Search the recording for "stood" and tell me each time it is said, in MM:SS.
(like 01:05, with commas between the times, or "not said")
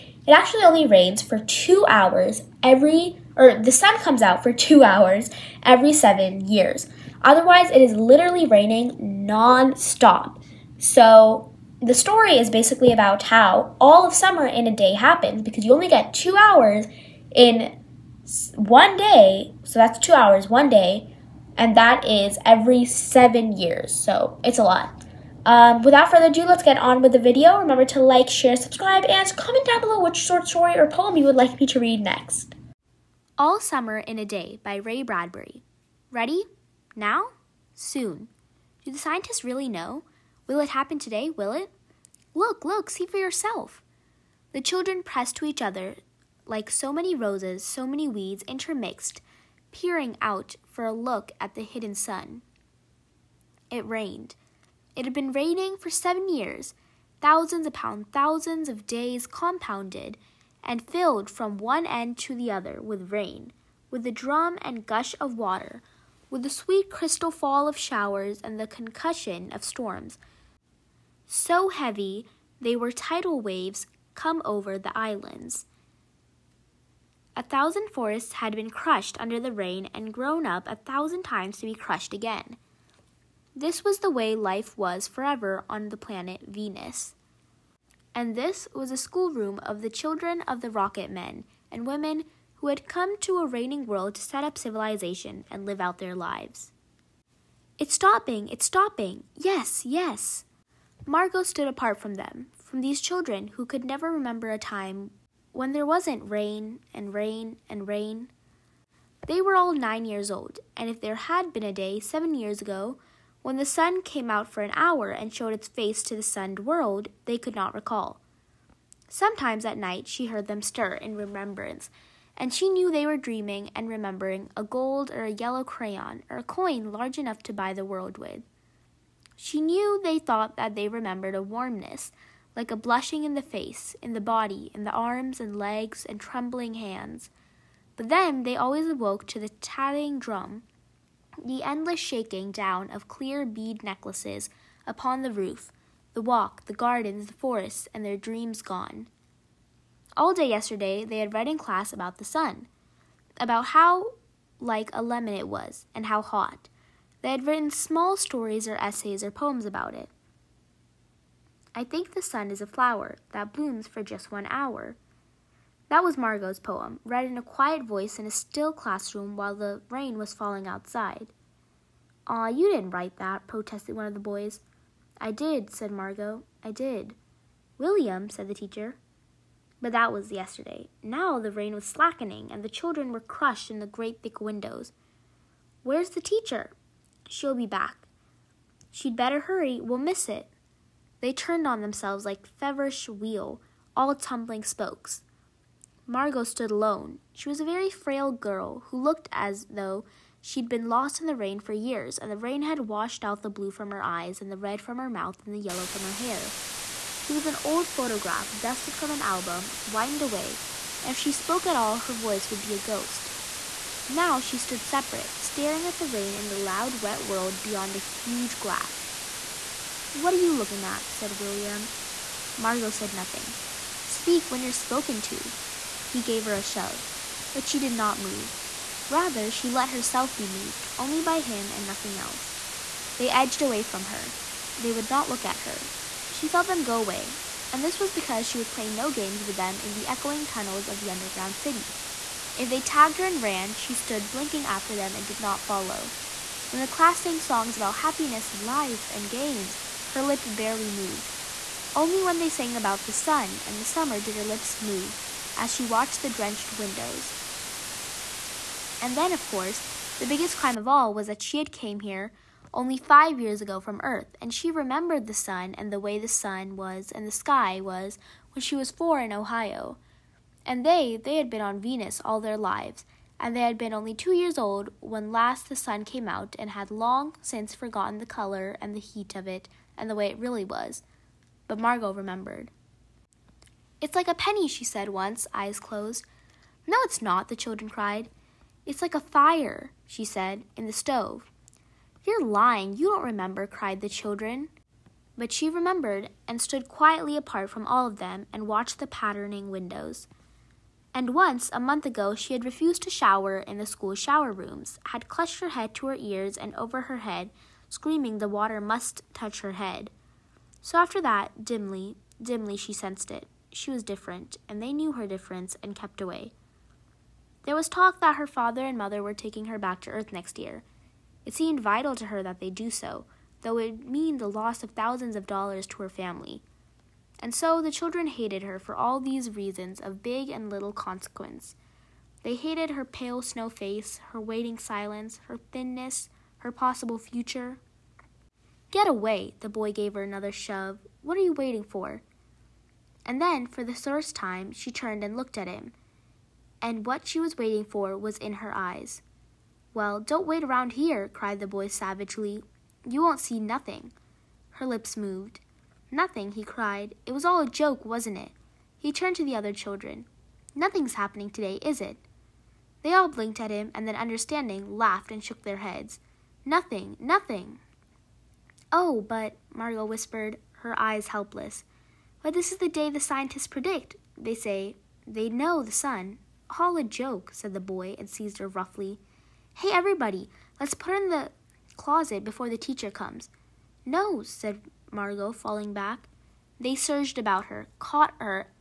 01:41, 03:16, 03:34, 04:03, 04:56.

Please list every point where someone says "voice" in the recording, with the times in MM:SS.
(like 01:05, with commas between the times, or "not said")
02:47, 03:32.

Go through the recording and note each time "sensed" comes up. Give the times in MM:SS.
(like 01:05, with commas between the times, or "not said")
05:12.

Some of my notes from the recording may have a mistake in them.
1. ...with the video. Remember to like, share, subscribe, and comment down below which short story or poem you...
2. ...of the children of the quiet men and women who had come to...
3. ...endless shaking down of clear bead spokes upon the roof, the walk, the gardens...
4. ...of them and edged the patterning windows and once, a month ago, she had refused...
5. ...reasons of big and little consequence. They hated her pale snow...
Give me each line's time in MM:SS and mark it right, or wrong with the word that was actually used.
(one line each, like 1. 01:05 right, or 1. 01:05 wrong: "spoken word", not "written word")
1. 00:27 right
2. 01:29 wrong: "rocket", not "quiet"
3. 02:21 wrong: "necklaces", not "spokes"
4. 04:58 wrong: "watched", not "edged"
5. 05:29 right.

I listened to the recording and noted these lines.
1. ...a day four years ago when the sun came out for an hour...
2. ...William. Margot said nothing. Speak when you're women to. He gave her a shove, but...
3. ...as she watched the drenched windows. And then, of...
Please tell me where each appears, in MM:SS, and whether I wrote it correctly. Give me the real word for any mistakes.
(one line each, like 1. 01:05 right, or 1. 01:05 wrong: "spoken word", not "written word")
1. 01:51 wrong: "seven", not "four"
2. 03:41 wrong: "spoken", not "women"
3. 04:15 right.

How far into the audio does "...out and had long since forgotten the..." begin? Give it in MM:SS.
04:36.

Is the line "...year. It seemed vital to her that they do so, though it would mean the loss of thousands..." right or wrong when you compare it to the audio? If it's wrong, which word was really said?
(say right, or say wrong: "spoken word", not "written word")
right.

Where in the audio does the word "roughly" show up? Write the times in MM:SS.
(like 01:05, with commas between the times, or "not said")
06:18.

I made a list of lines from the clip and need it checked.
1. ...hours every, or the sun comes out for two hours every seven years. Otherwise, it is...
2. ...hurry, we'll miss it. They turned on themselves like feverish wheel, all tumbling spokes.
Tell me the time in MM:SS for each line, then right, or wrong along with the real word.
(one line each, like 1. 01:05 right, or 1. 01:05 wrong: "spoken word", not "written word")
1. 00:01 right
2. 03:09 right.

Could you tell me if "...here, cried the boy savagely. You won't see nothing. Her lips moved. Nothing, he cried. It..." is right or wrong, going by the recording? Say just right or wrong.
right.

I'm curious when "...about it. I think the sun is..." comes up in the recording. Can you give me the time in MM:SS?
02:39.